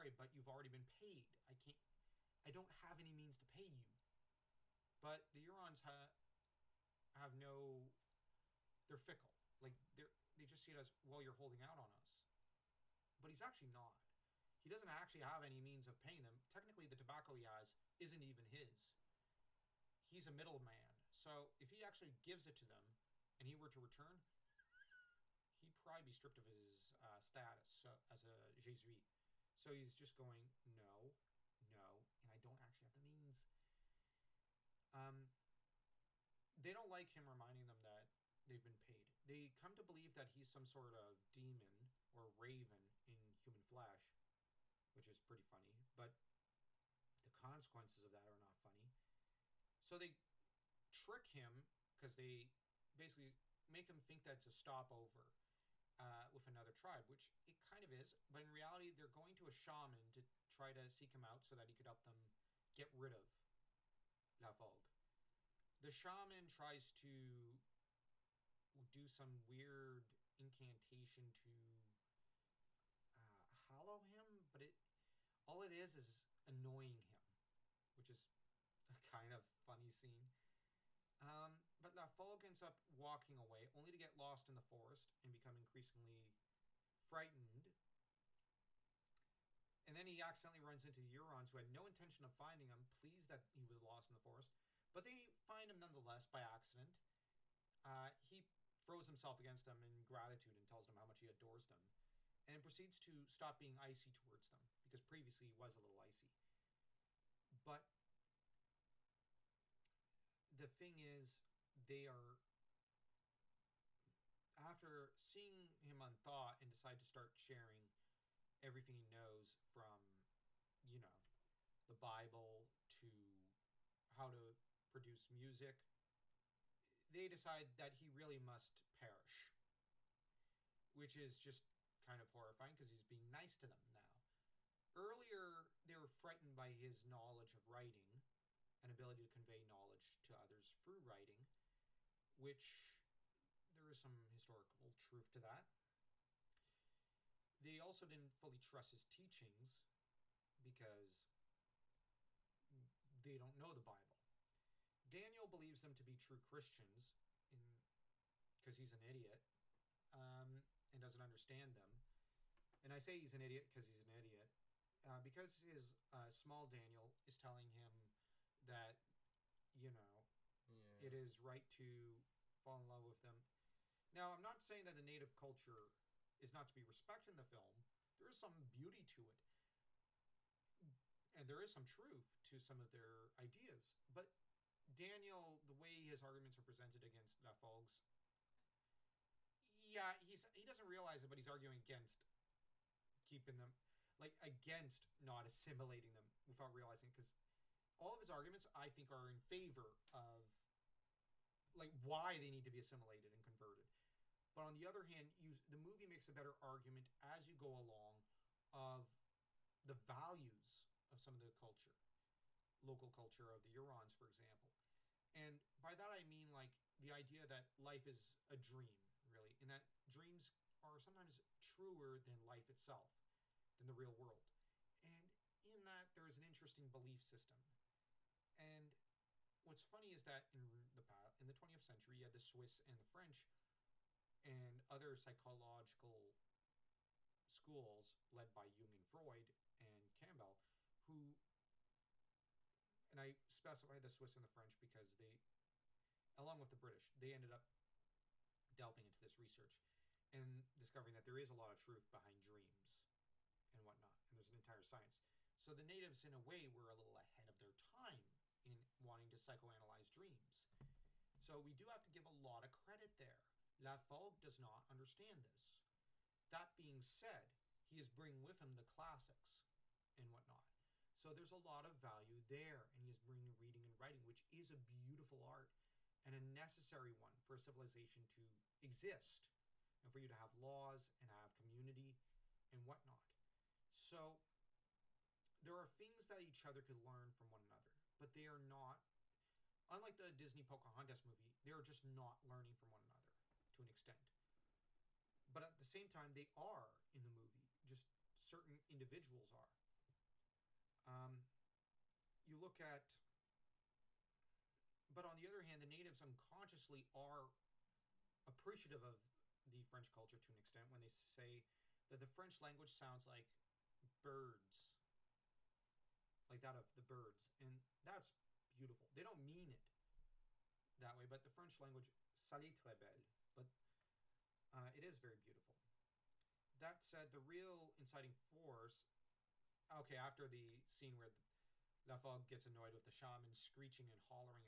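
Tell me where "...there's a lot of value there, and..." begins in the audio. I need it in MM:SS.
04:31.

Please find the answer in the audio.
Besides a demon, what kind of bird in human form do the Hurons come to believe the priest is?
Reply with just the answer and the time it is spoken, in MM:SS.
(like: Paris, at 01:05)
Raven, at 00:42.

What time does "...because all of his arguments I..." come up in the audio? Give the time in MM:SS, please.
03:17.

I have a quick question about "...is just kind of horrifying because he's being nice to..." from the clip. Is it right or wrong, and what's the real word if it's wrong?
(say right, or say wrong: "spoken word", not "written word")
right.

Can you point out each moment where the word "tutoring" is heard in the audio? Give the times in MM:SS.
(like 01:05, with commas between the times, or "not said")
not said.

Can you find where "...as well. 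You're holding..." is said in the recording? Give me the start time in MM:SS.
00:10.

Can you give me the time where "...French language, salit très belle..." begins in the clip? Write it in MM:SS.
05:21.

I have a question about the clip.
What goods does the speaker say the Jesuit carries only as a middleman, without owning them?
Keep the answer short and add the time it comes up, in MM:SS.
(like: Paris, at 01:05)
Tobacco, at 00:16.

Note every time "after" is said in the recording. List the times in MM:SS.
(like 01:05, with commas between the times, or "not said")
01:54, 05:30.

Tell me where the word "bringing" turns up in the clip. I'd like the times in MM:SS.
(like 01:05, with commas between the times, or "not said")
04:28, 04:33.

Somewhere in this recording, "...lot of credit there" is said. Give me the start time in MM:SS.
04:22.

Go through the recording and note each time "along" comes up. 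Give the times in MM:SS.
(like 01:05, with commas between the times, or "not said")
03:27, 04:06.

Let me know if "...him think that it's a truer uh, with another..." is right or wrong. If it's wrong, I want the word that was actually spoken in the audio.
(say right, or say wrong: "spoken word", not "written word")
wrong: "stopover", not "truer".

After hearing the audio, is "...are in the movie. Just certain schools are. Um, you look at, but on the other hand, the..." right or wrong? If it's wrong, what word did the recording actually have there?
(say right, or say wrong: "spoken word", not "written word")
wrong: "individuals", not "schools".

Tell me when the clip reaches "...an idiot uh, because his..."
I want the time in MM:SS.
02:44.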